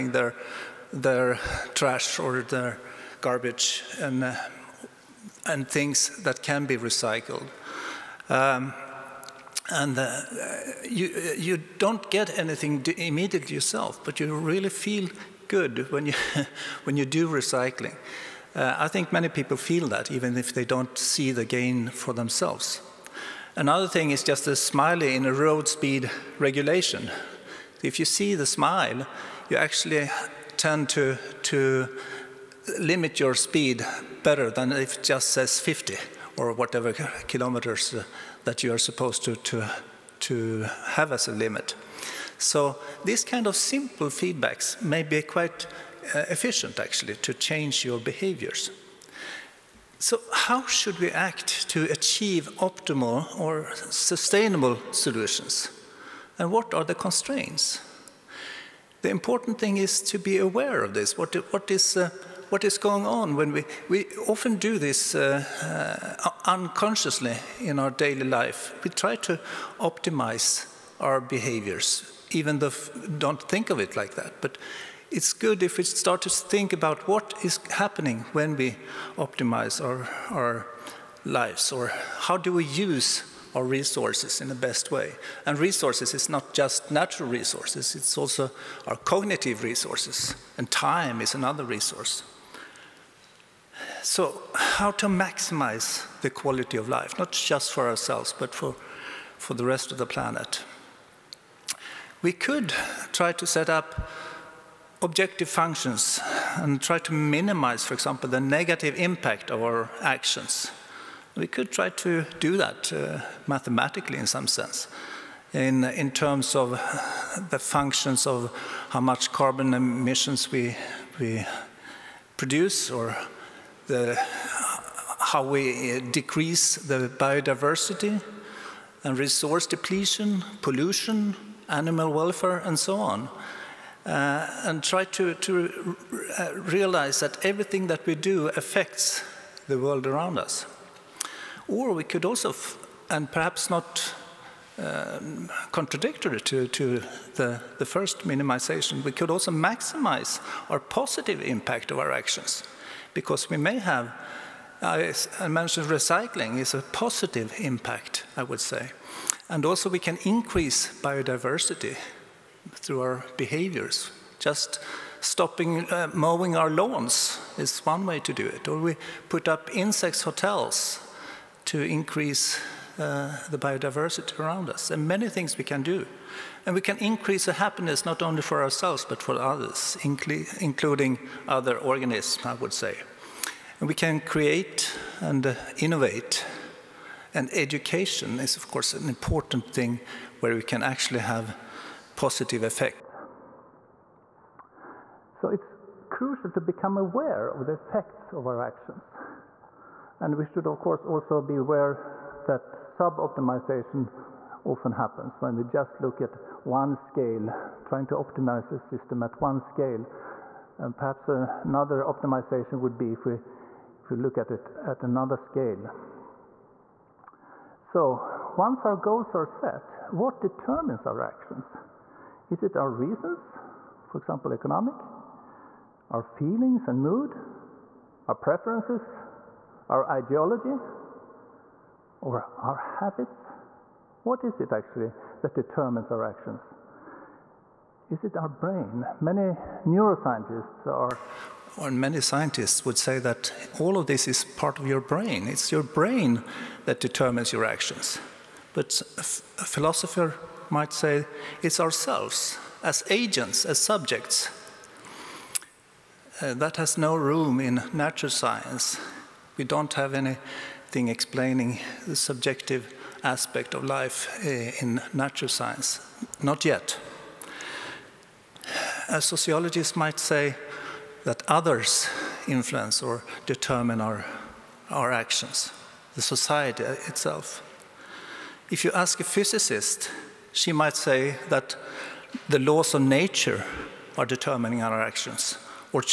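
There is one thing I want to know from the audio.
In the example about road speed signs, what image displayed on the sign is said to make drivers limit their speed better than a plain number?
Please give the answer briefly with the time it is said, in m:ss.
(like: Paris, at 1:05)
smiley, at 0:24.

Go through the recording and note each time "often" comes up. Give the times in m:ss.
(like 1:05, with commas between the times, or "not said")
1:04, 3:24.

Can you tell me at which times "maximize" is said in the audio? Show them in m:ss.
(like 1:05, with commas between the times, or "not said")
1:35, 2:29.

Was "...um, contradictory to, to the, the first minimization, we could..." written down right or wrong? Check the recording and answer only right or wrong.
right.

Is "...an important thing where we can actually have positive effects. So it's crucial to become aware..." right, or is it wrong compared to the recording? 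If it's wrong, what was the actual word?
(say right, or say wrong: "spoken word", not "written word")
right.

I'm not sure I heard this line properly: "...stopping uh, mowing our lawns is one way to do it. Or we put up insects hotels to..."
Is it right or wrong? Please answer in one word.
right.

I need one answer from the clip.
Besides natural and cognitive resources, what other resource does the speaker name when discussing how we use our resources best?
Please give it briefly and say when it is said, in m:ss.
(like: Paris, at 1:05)
time, at 1:30.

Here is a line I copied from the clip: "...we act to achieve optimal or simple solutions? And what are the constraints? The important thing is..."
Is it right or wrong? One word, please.
wrong.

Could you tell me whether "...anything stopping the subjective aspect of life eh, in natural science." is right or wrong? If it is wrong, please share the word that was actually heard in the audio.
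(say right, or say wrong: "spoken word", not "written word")
wrong: "explaining", not "stopping".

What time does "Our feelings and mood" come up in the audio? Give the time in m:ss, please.
3:46.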